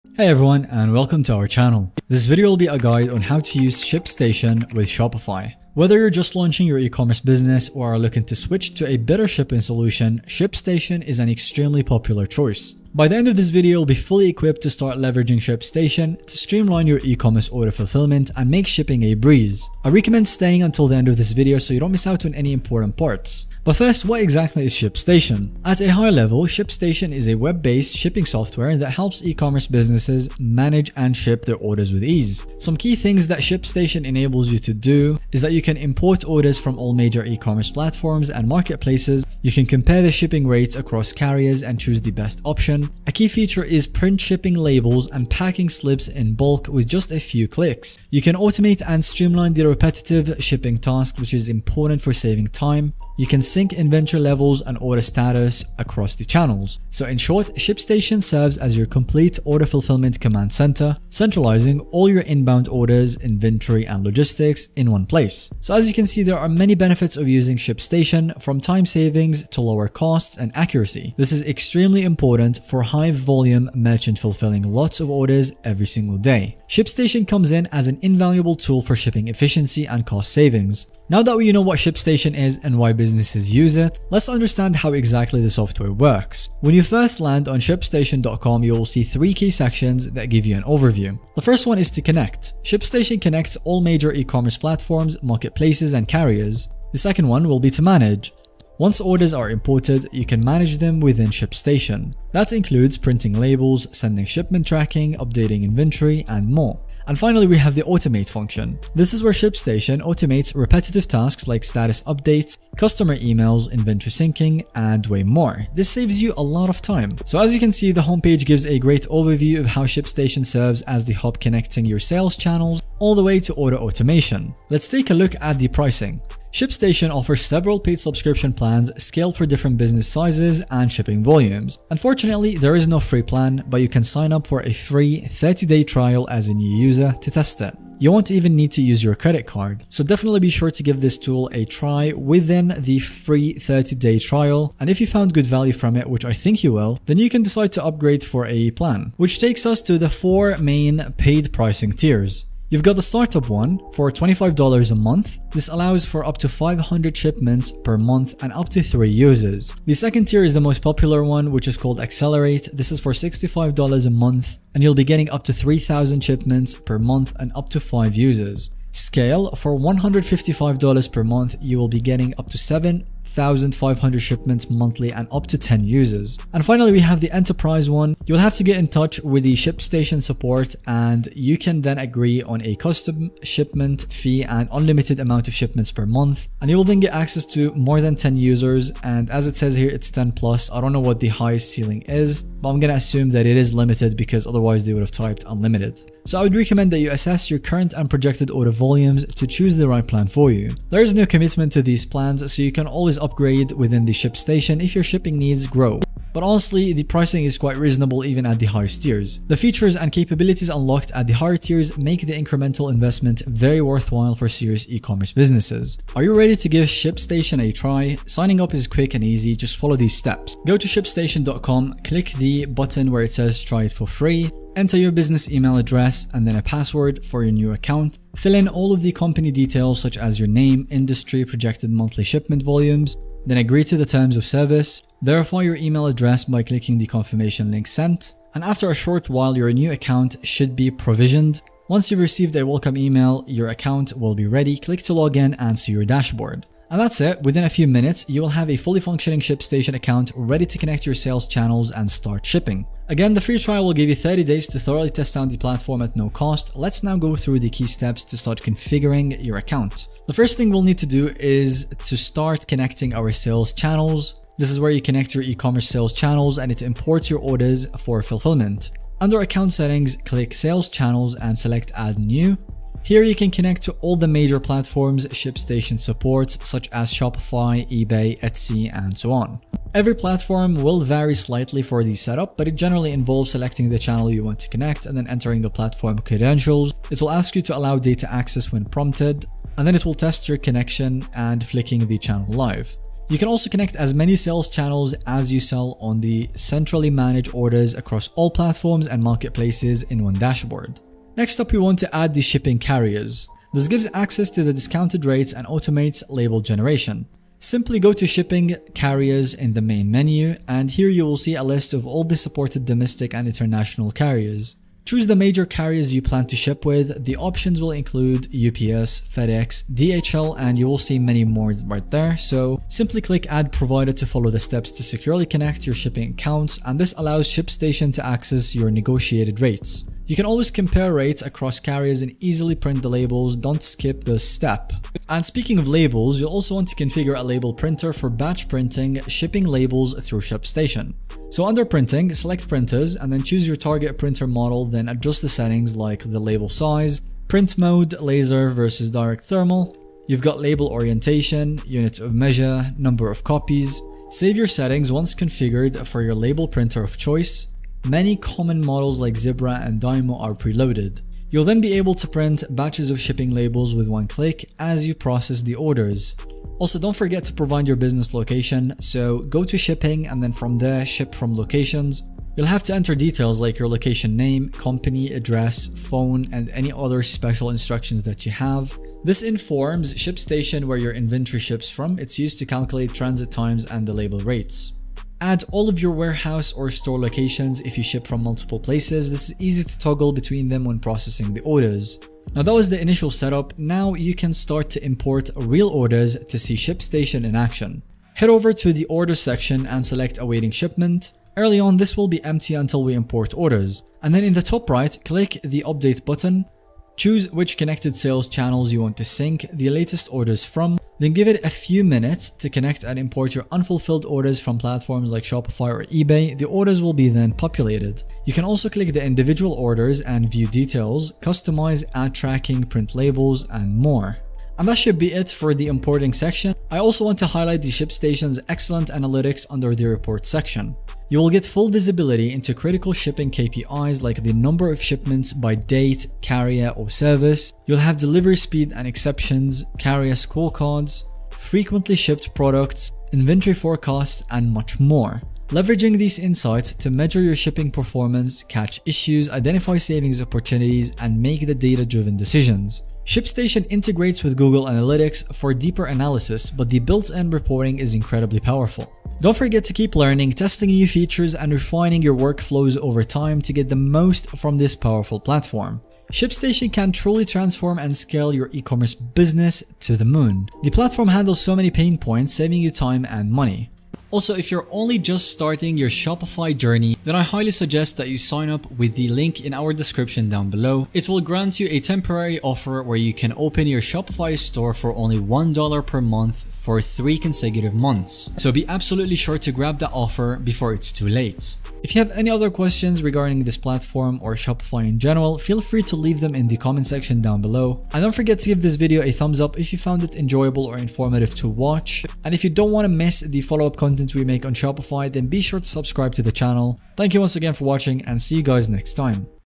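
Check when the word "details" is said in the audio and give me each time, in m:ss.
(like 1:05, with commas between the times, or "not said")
3:49, 6:13, 7:00.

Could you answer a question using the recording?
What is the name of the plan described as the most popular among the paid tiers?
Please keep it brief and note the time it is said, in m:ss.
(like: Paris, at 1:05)
Accelerate, at 2:41.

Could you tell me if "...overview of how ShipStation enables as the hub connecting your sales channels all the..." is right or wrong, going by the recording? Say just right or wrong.
wrong.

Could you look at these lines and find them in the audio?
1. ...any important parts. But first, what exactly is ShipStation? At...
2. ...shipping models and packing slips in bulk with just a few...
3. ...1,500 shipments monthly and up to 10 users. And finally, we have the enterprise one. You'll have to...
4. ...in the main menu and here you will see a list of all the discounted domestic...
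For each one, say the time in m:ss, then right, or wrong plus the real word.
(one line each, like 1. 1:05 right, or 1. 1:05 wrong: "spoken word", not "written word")
1. 0:22 right
2. 0:44 wrong: "labels", not "models"
3. 2:53 right
4. 5:09 wrong: "supported", not "discounted".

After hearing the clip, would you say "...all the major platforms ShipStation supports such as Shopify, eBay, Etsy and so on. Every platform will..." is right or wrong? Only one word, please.
right.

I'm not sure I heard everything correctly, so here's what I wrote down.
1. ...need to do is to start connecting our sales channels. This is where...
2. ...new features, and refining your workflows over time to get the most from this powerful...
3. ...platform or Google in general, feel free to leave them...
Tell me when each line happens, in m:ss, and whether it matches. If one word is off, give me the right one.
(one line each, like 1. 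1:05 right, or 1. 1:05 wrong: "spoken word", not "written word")
1. 4:20 right
2. 7:40 right
3. 8:13 wrong: "Shopify", not "Google".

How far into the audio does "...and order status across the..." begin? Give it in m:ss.
0:54.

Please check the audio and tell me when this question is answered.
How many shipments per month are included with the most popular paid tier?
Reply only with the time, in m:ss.
2:45.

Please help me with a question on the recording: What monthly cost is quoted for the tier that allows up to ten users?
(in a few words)
$155.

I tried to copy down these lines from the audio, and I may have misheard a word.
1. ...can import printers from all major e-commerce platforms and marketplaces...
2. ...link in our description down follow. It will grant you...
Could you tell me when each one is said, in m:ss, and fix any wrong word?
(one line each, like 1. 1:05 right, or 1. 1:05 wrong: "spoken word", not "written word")
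1. 0:35 wrong: "orders", not "printers"
2. 7:59 wrong: "below", not "follow".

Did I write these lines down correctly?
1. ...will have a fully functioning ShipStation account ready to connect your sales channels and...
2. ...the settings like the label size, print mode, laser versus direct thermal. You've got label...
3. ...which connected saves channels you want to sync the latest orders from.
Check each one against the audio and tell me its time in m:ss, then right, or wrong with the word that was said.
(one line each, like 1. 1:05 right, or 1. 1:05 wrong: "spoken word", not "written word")
1. 4:08 right
2. 5:45 right
3. 6:47 wrong: "sales", not "saves".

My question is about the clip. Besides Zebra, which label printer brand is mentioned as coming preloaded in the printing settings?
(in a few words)
Dymo.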